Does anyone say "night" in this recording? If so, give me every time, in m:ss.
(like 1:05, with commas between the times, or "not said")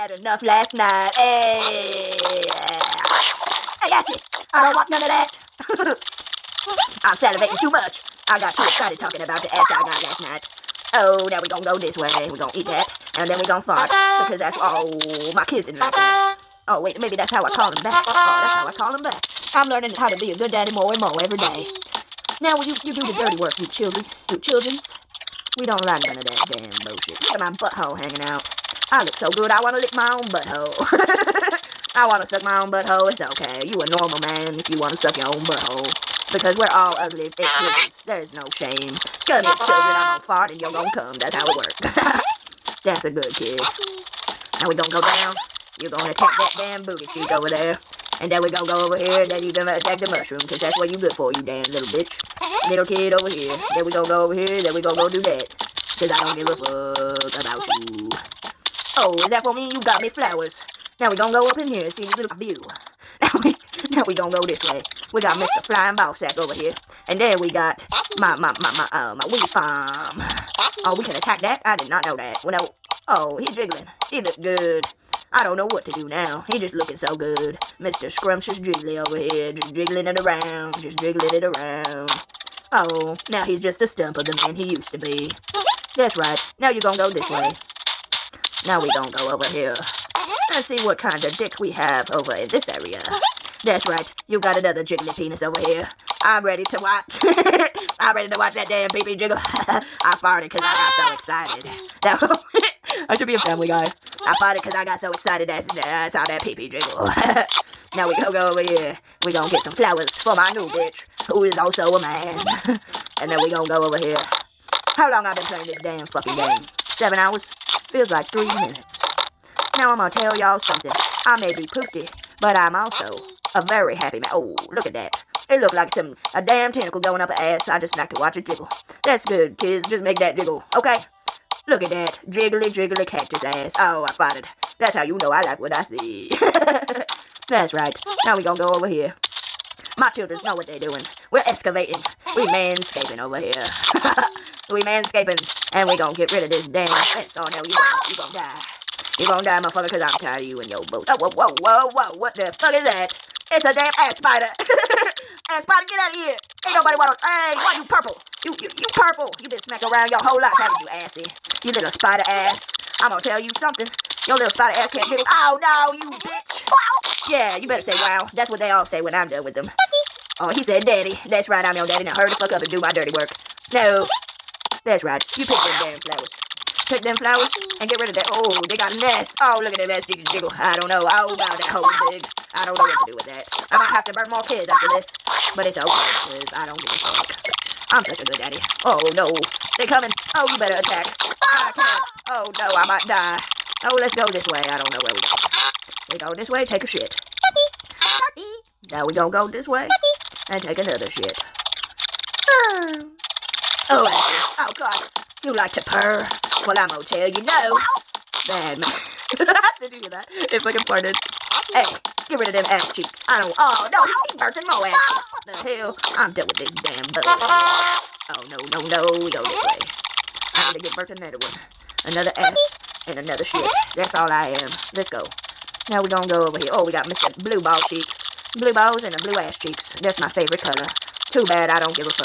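0:00, 0:10.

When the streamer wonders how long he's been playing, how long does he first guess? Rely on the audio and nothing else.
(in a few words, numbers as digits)
7 hours.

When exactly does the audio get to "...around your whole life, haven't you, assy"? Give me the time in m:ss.
2:39.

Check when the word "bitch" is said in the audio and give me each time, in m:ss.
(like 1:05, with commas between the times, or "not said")
0:51, 1:50, 2:46.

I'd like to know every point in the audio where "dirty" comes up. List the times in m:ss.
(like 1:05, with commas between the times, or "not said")
0:23, 2:52.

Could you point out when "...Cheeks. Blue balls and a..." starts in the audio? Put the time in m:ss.
3:47.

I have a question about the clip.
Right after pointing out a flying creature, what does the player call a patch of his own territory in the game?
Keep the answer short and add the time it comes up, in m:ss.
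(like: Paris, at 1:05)
weed farm, at 1:09.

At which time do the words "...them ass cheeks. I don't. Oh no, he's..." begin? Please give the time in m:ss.
3:32.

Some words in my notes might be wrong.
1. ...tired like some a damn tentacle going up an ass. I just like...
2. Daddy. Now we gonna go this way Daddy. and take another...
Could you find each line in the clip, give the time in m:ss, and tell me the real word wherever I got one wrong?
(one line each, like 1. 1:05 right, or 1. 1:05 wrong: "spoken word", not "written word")
1. 2:05 wrong: "looked", not "tired"
2. 3:18 right.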